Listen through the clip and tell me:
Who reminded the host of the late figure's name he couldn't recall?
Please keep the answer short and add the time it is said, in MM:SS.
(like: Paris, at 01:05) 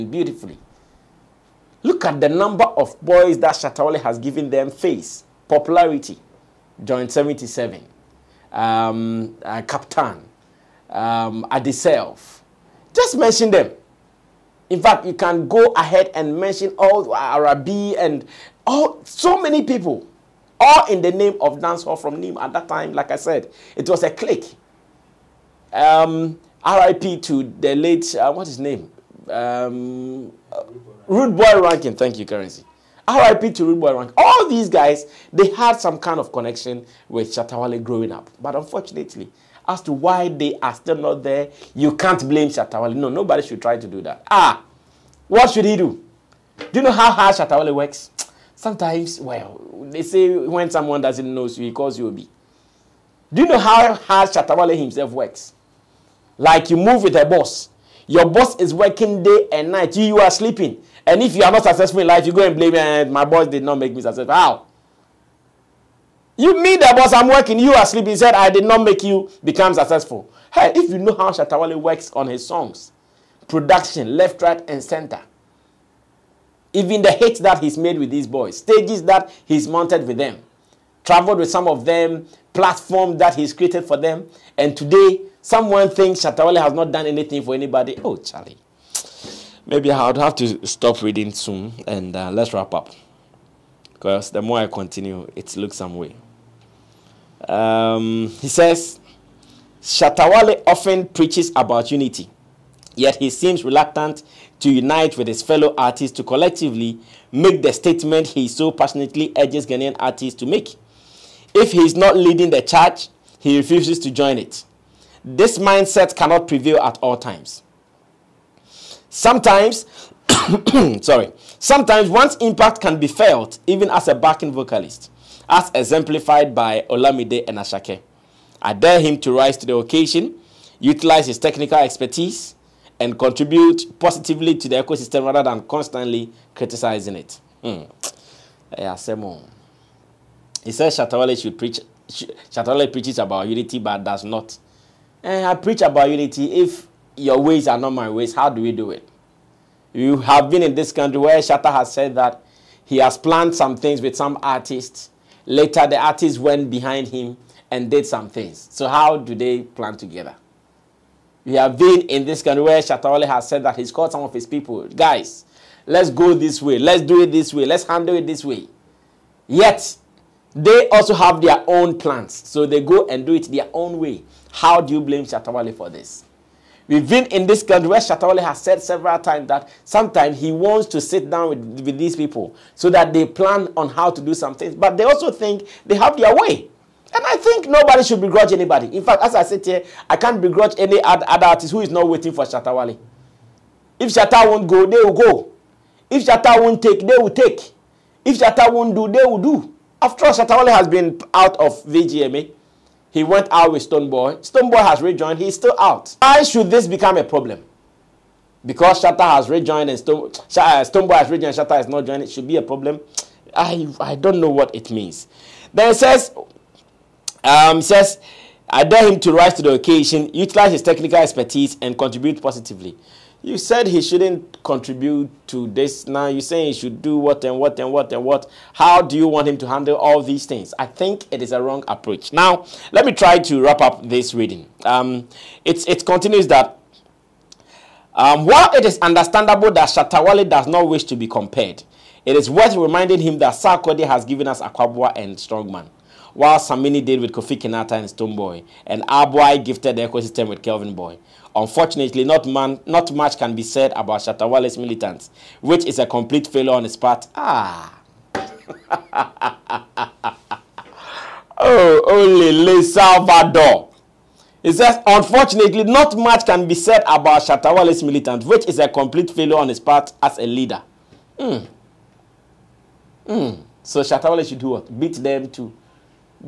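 Currency, at 00:32.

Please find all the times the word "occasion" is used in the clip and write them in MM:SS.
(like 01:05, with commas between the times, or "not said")
02:09, 03:39.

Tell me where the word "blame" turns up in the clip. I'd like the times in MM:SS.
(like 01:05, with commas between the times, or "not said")
00:42, 01:02, 02:55.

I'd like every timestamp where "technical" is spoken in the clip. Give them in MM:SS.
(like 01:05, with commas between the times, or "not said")
02:11, 03:40.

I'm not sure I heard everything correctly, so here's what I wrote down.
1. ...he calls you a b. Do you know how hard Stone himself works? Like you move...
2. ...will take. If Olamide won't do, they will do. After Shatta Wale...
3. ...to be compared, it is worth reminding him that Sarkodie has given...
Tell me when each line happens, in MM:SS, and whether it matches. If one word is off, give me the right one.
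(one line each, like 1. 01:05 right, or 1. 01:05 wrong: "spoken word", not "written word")
1. 00:51 wrong: "Shatawale", not "Stone"
2. 03:17 wrong: "Shatta", not "Olamide"
3. 04:01 right.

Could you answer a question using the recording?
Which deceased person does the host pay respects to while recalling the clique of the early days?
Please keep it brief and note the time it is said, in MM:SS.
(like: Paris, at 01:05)
Rude Boy Ranking, at 00:31.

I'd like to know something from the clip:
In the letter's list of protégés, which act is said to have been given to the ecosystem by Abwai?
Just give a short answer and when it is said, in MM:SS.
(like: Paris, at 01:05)
Kelvin Boy, at 04:10.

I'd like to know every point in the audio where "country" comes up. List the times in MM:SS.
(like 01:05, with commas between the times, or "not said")
02:30, 02:42, 02:57.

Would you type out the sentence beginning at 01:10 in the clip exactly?
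Hey, if you know how Shatta Wale works on his songs, production, left, right, and center.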